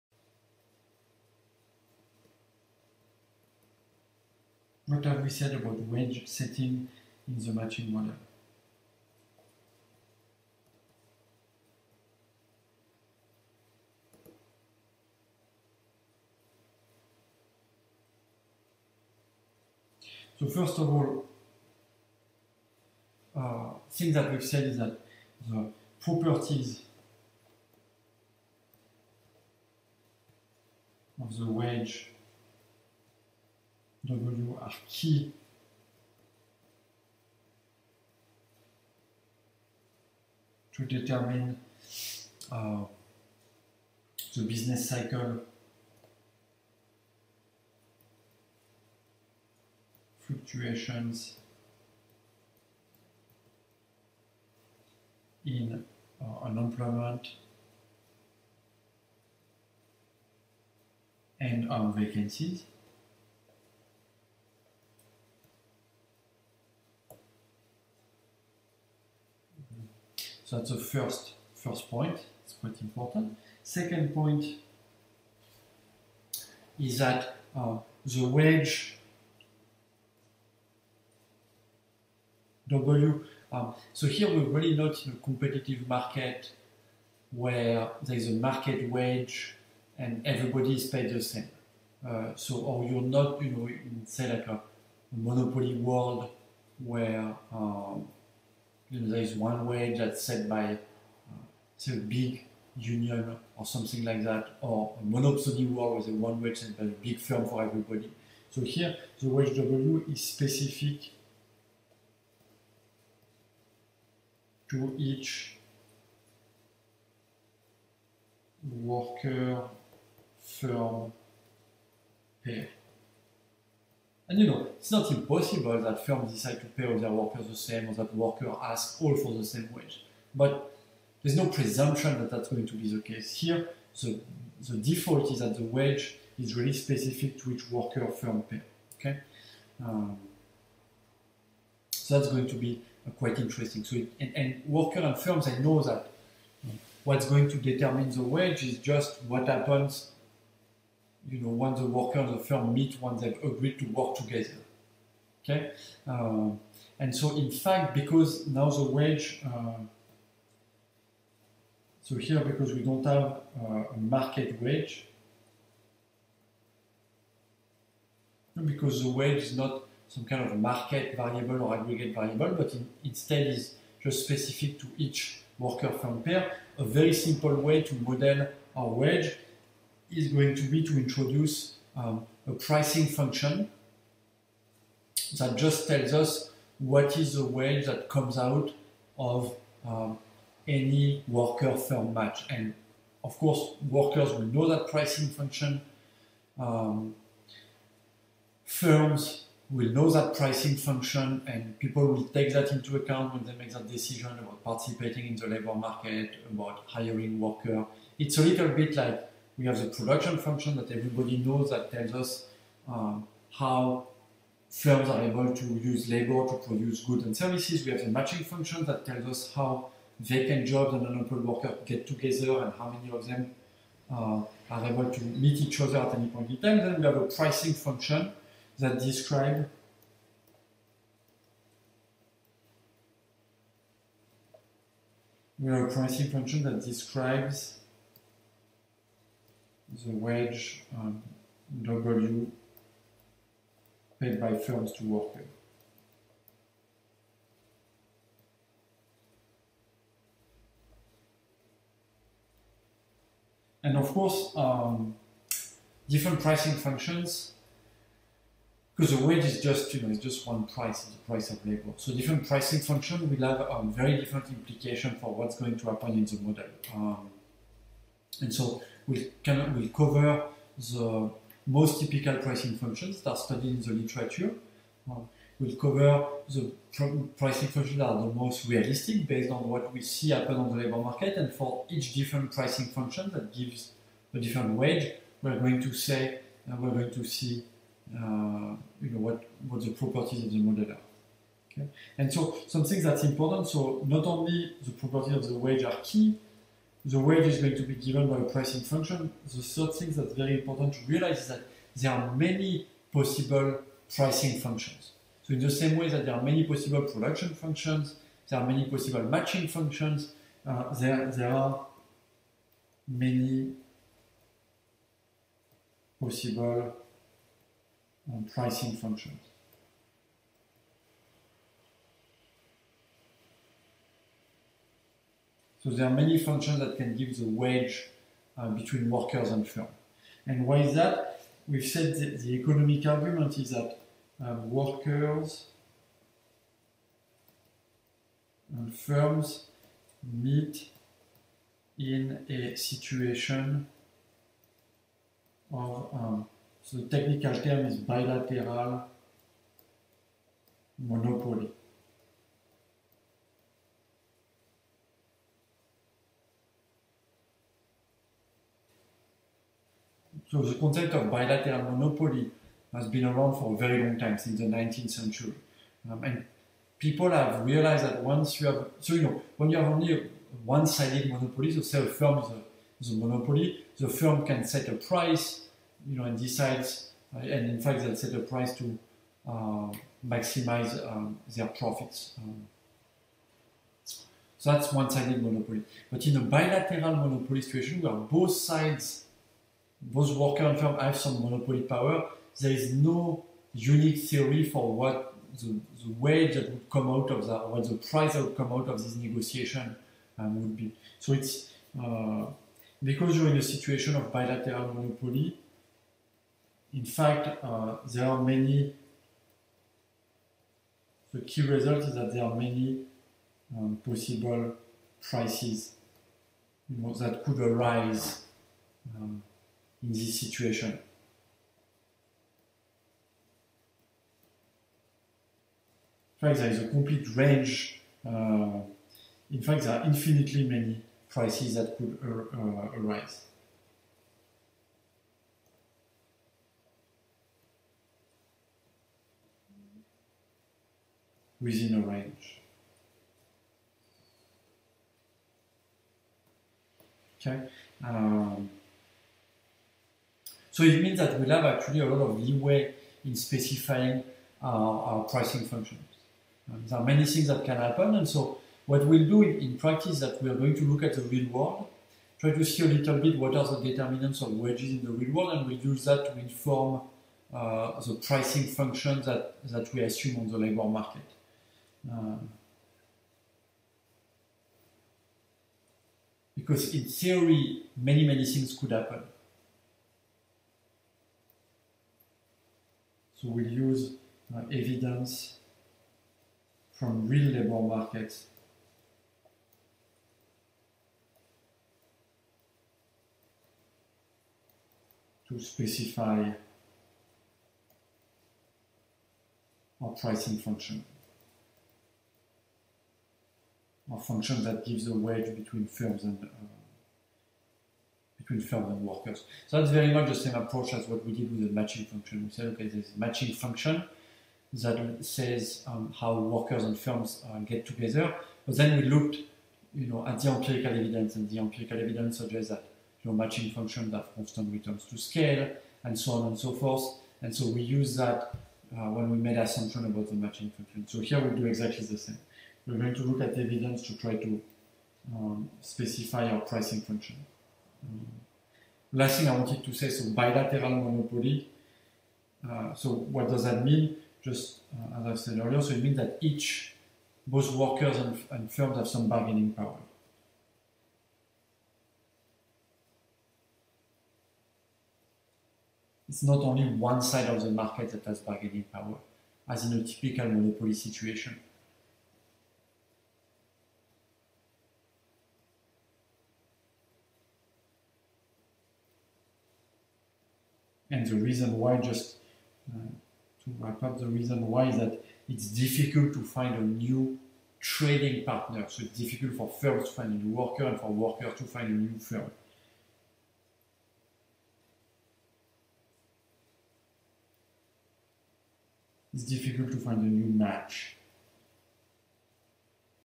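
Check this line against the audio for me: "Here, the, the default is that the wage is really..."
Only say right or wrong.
right.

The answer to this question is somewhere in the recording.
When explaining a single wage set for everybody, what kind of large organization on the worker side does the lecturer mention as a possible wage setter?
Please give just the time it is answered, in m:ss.
1:41.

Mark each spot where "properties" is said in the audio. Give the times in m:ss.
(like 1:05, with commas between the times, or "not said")
0:26, 4:49, 4:54.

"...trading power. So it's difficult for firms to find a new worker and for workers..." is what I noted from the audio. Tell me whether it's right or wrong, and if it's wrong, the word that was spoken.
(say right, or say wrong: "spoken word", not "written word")
wrong: "partner", not "power".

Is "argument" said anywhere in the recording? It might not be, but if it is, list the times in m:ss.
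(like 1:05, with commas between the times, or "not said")
5:33.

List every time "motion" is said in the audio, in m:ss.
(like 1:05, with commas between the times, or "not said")
not said.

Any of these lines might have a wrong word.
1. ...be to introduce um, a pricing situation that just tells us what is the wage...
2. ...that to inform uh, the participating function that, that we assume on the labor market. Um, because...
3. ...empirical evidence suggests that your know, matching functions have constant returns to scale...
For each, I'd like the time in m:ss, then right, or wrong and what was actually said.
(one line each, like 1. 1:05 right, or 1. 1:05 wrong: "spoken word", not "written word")
1. 3:00 wrong: "function", not "situation"
2. 7:46 wrong: "pricing", not "participating"
3. 8:41 right.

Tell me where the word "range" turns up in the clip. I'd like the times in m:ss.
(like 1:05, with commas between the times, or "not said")
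7:07, 7:22.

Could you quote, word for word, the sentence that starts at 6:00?
So the concept of bilateral monopoly has been around for a very long time, since the 19th century.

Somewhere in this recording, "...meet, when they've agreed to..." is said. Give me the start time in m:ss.
2:32.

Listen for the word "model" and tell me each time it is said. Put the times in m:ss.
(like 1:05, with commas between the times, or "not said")
0:07, 2:57, 4:26, 4:50.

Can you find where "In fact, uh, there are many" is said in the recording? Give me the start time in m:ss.
6:46.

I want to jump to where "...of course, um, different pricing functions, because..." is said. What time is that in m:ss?
4:13.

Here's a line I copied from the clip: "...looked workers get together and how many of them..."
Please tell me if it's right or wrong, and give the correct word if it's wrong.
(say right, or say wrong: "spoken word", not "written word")
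wrong: "unemployed", not "looked".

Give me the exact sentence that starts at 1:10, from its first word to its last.
So that's the first, first point, it's quite important.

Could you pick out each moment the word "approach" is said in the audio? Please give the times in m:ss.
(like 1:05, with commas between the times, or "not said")
8:30.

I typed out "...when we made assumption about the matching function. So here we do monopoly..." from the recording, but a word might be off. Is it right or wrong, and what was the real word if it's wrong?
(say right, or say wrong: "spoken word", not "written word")
wrong: "exactly", not "monopoly".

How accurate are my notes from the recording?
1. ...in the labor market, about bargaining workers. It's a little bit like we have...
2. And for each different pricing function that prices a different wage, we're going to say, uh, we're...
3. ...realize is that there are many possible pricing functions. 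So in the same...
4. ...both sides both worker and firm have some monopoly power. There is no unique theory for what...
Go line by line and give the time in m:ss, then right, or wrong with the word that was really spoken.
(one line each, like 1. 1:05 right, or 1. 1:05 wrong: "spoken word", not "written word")
1. 3:25 wrong: "hiring", not "bargaining"
2. 4:41 wrong: "gives", not "prices"
3. 5:01 right
4. 6:28 right.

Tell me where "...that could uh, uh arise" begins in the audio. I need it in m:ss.
7:11.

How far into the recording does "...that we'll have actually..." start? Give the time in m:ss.
7:31.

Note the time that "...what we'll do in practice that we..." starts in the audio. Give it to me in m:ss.
7:38.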